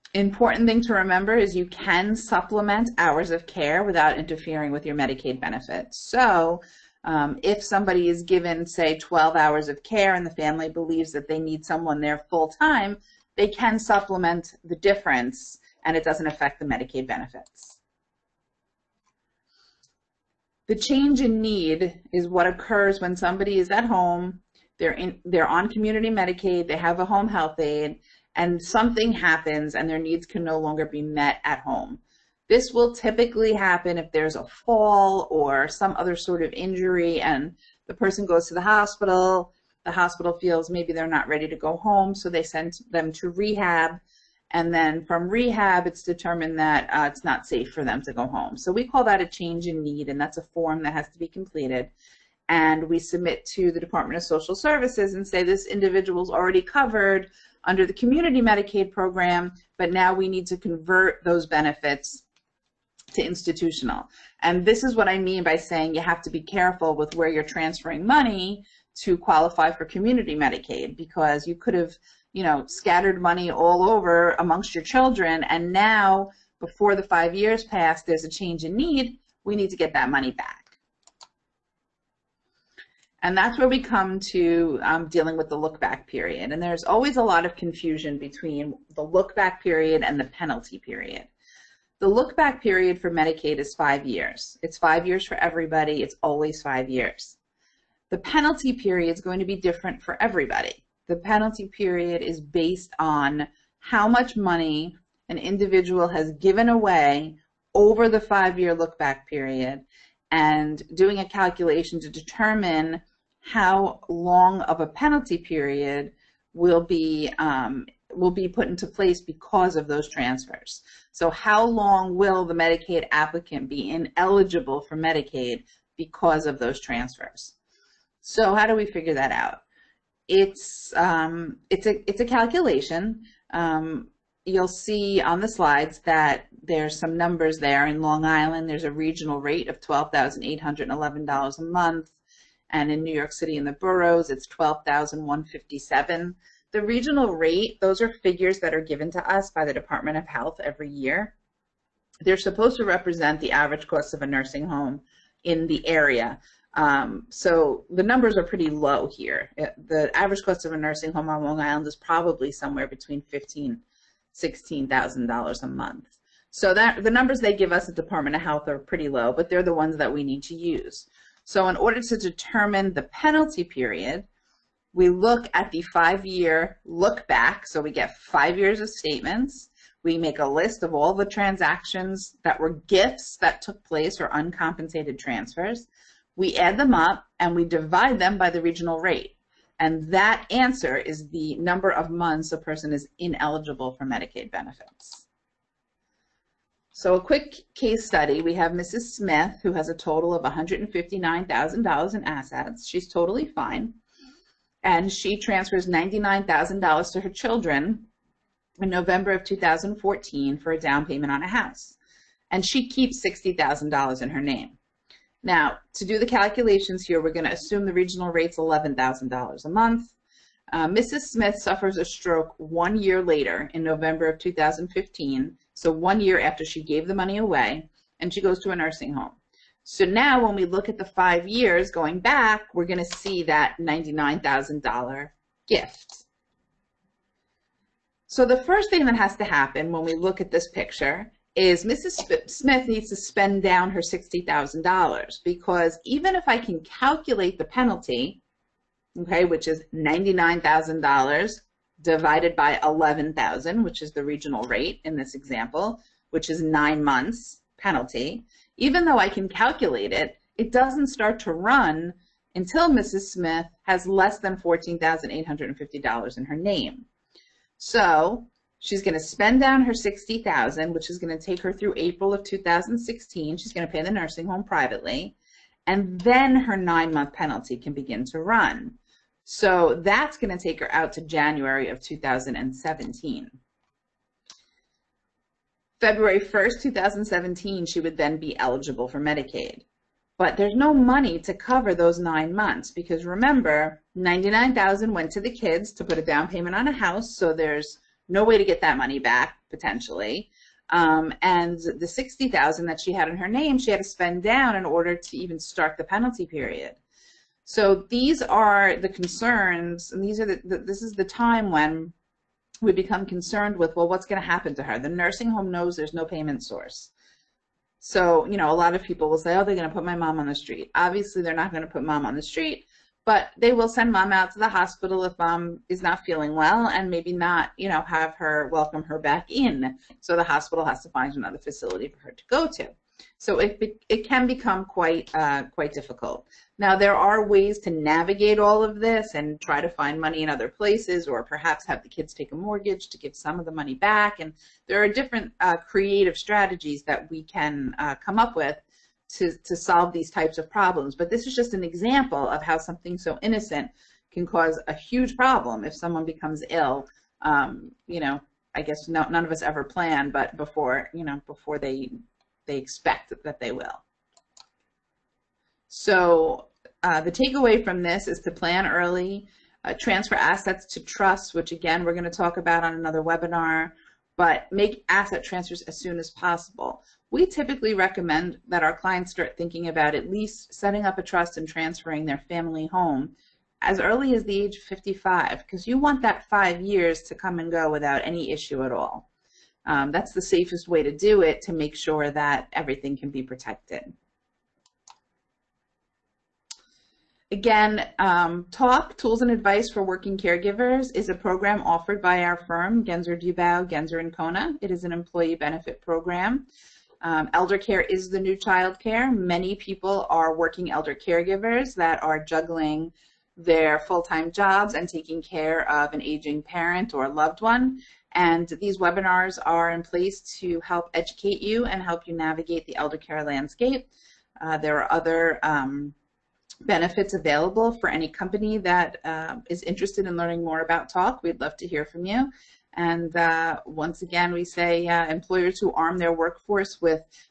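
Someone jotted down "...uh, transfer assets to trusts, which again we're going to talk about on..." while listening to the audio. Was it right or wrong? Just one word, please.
right.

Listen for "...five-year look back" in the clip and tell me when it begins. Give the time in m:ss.
2:55.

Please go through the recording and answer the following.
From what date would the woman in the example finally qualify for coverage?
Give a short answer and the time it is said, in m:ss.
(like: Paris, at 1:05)
February 1st, 2017, at 4:45.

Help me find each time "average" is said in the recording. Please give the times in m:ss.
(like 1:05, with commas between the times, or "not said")
2:33, 2:40.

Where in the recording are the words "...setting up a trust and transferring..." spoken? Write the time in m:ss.
6:20.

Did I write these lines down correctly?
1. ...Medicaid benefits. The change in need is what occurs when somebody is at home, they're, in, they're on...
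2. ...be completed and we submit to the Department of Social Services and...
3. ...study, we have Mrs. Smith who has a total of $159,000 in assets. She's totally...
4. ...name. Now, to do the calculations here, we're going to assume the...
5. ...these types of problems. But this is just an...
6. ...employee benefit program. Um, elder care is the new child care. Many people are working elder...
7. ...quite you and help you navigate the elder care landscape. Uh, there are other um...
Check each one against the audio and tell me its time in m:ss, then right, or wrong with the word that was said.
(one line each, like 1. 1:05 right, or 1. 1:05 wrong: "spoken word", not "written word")
1. 0:16 right
2. 0:51 right
3. 3:18 right
4. 3:34 right
5. 5:50 right
6. 6:45 right
7. 7:01 wrong: "educate", not "quite".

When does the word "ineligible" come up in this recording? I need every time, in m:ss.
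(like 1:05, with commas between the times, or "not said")
2:03, 3:13.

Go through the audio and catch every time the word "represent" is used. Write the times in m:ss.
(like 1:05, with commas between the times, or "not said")
2:32.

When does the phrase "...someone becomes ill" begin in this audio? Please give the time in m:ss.
5:55.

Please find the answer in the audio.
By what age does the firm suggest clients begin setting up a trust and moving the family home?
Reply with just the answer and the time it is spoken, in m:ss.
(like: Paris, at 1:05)
55, at 6:24.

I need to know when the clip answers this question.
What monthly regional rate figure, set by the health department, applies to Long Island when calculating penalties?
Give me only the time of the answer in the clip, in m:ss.
2:19.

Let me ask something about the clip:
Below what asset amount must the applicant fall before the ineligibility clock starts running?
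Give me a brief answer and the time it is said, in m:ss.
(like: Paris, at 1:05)
$14,850, at 4:24.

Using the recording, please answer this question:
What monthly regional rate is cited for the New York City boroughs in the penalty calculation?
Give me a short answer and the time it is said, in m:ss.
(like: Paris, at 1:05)
12,157, at 2:24.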